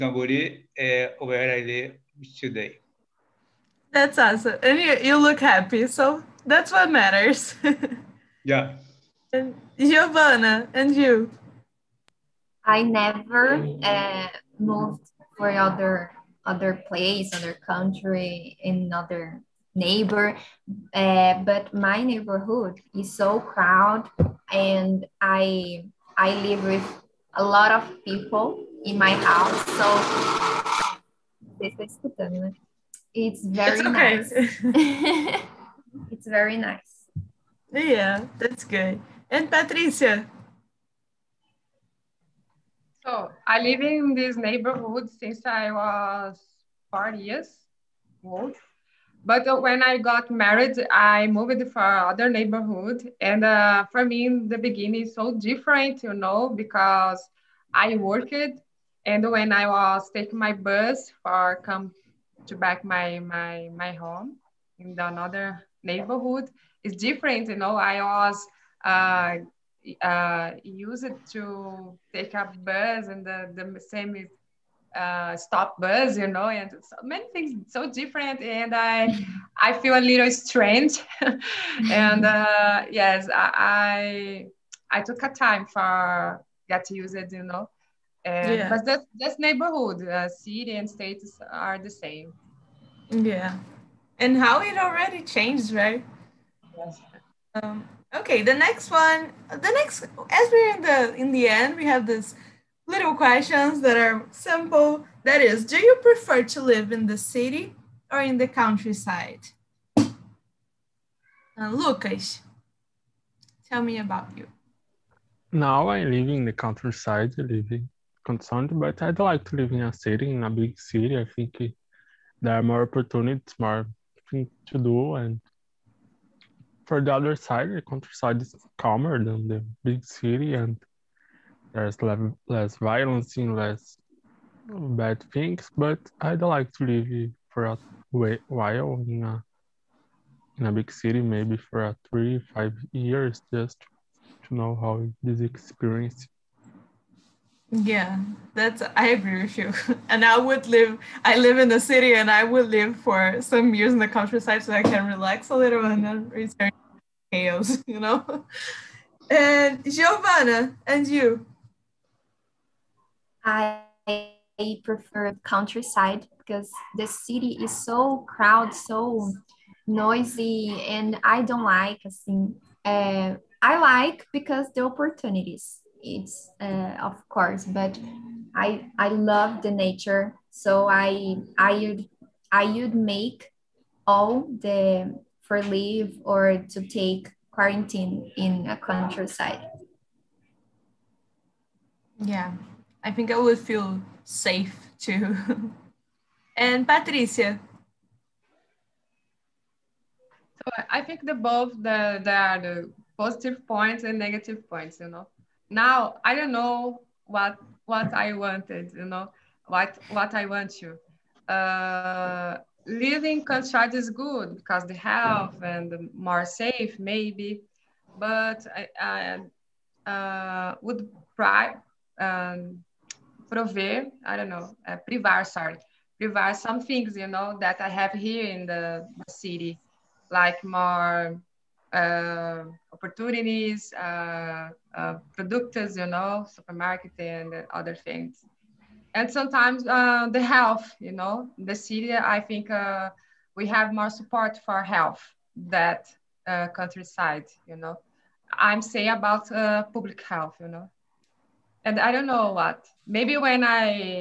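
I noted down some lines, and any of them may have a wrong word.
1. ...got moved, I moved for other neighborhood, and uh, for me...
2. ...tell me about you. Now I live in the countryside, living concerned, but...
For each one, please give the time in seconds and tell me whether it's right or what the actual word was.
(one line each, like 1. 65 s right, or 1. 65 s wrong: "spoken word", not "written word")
1. 49 s wrong: "married", not "moved"
2. 113 s right.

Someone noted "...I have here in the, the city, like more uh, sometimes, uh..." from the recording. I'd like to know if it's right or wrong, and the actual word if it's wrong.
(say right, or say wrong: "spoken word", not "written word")
wrong: "opportunities", not "sometimes".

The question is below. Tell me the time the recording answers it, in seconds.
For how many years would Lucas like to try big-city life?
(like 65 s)
142 s.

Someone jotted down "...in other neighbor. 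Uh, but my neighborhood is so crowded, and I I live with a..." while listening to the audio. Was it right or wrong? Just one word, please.
right.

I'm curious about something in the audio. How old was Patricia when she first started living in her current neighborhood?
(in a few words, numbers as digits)
4.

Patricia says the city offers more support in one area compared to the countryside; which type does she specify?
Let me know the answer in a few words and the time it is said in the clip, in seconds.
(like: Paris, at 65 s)
public health, at 249 s.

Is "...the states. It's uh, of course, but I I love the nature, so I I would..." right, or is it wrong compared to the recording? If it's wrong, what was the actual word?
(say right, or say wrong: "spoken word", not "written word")
wrong: "opportunities", not "states".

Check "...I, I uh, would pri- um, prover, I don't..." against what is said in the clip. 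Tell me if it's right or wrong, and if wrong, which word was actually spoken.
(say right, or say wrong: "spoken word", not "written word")
right.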